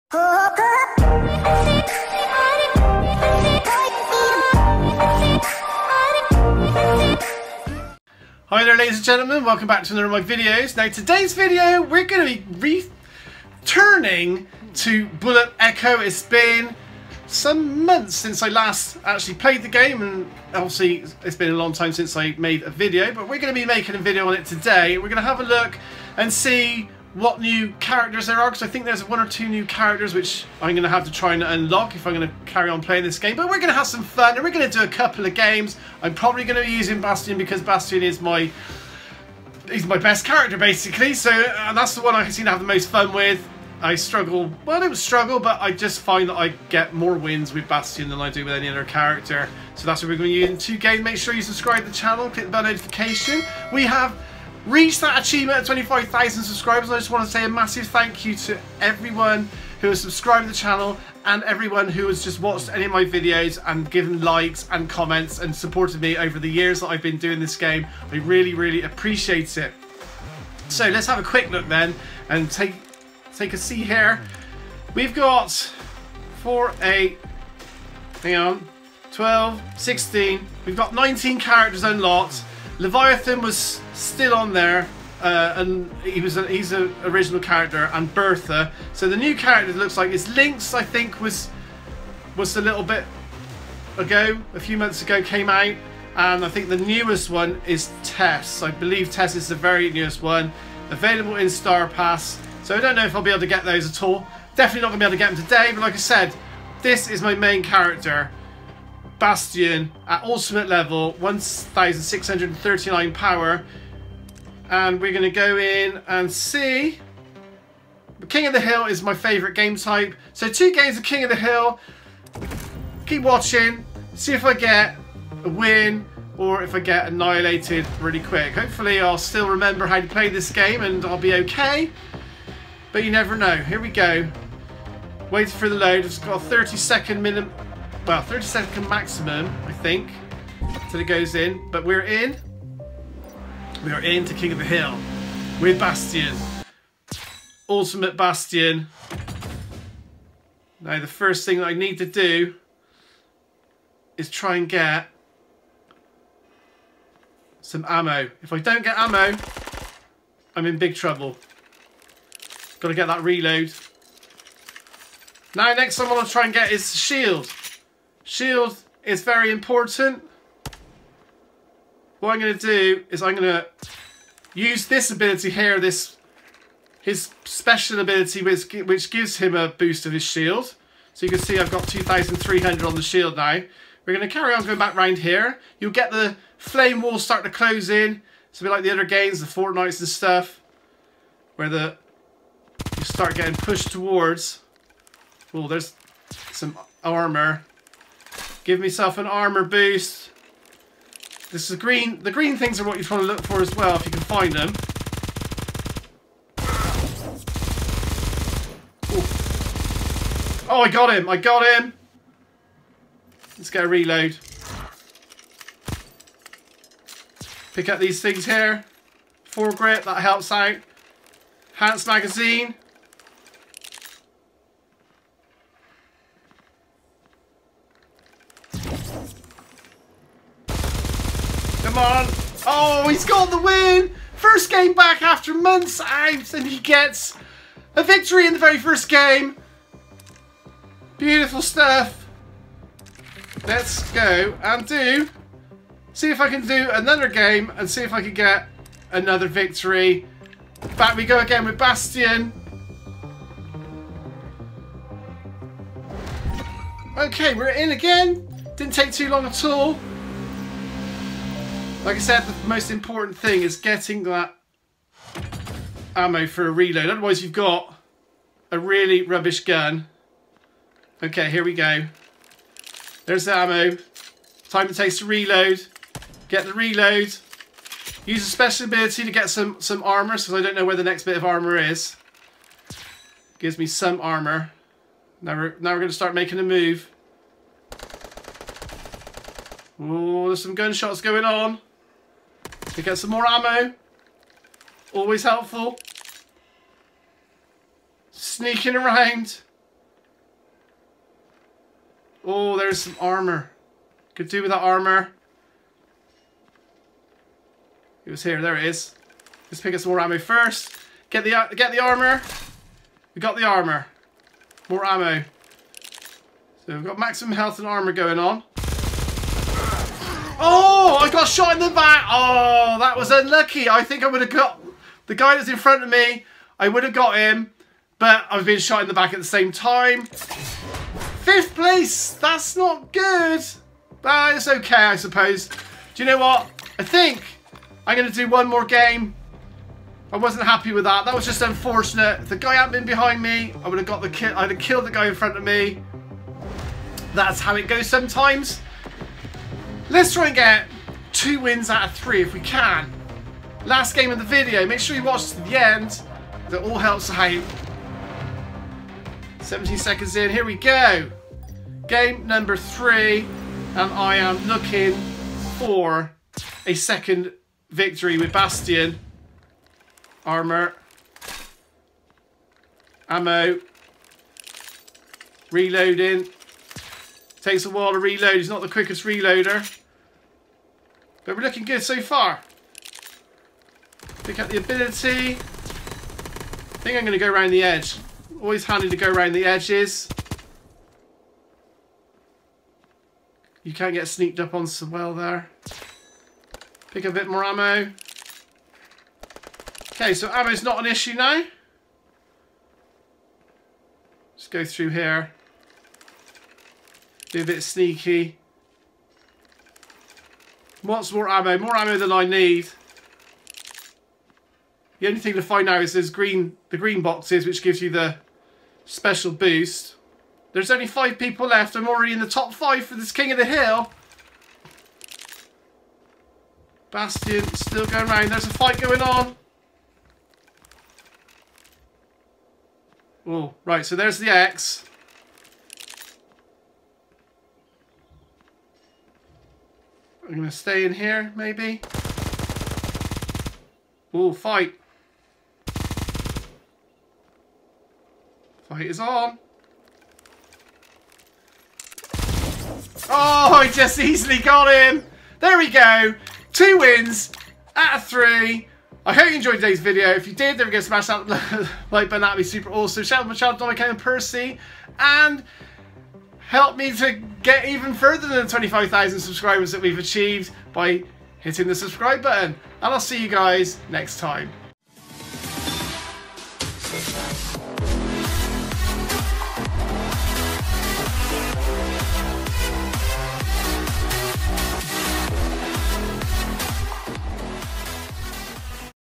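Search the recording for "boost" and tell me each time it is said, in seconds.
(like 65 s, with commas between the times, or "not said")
179 s, 199 s, 419 s.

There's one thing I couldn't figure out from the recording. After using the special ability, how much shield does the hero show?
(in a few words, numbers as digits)
2,300.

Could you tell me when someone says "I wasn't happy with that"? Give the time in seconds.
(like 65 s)
340 s.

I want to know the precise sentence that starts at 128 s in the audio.
Hopefully I'll still remember how to play this game and I'll be okay.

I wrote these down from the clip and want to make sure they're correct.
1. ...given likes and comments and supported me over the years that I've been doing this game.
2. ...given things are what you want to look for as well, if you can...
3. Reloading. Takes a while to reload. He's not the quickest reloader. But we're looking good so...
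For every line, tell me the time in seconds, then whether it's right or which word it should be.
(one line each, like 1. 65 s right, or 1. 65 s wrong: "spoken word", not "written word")
1. 63 s right
2. 202 s wrong: "green", not "given"
3. 375 s right.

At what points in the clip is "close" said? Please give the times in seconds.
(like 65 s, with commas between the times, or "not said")
187 s.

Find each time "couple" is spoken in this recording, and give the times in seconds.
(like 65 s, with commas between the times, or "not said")
34 s.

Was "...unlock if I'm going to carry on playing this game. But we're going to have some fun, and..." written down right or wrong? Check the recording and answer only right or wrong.
right.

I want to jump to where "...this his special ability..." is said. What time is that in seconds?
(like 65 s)
175 s.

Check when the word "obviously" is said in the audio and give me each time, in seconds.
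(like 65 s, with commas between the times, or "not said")
20 s.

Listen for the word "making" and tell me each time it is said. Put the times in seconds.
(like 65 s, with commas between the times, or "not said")
23 s, 286 s.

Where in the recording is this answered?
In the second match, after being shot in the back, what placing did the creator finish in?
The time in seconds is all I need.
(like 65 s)
330 s.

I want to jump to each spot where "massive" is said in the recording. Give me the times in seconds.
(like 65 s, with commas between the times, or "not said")
57 s.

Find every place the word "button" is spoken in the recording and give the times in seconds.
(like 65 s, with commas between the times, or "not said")
462 s, 472 s.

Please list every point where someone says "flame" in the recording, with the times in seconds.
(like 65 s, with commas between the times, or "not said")
186 s.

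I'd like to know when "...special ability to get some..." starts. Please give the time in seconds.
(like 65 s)
278 s.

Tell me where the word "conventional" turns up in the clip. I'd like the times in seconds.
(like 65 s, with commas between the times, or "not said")
not said.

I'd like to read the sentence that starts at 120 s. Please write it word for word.
So two games of King of the Hill.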